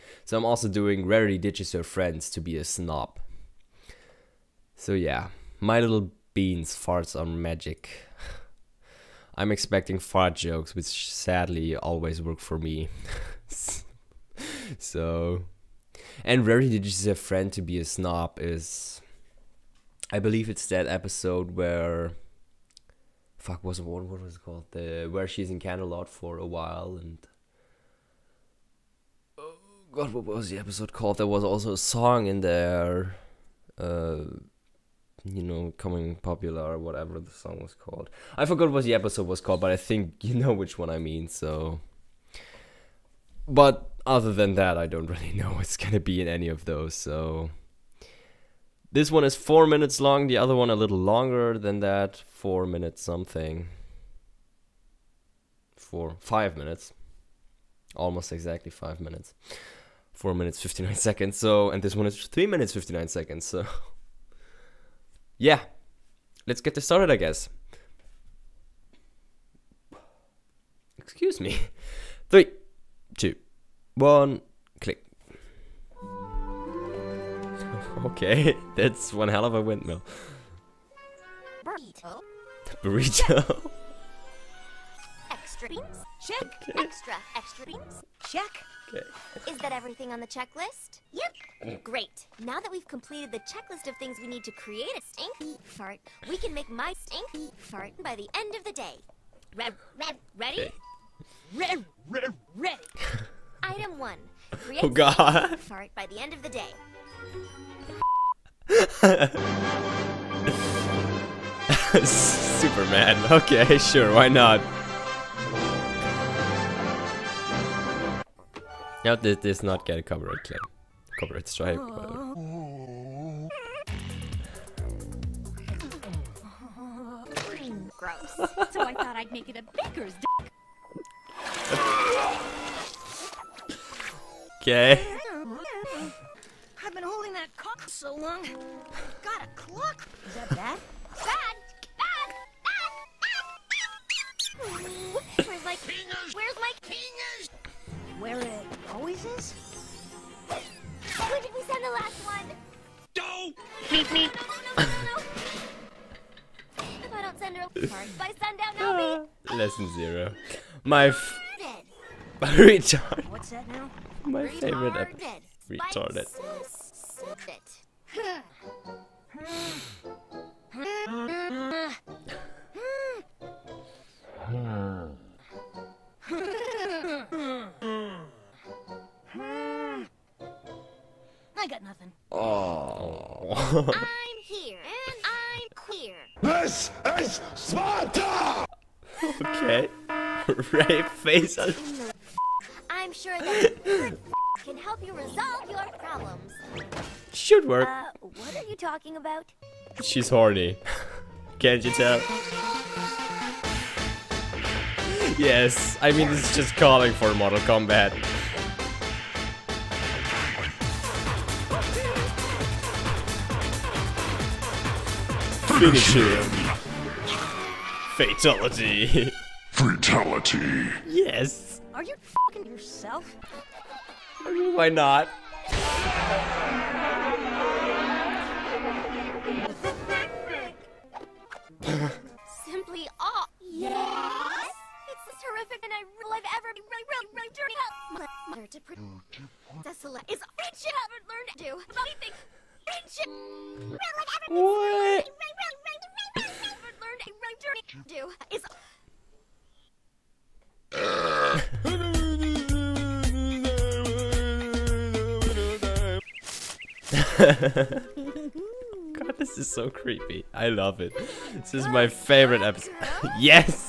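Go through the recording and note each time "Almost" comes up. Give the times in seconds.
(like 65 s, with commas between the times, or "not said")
57 s.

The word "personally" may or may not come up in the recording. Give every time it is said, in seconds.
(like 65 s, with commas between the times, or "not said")
not said.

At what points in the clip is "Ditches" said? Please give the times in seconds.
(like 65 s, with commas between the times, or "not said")
1 s.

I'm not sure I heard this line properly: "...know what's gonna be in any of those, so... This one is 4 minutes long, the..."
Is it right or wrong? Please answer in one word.
right.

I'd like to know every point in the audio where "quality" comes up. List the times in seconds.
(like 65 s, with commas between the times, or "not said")
not said.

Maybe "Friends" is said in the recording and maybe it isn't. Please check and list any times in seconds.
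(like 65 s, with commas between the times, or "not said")
1 s, 17 s.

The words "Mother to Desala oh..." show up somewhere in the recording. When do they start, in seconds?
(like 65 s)
238 s.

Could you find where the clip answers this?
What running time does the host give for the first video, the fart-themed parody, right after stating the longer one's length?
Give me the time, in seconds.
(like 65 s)
62 s.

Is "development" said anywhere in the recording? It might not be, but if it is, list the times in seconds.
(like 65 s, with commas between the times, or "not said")
not said.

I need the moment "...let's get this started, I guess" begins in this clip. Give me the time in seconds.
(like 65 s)
66 s.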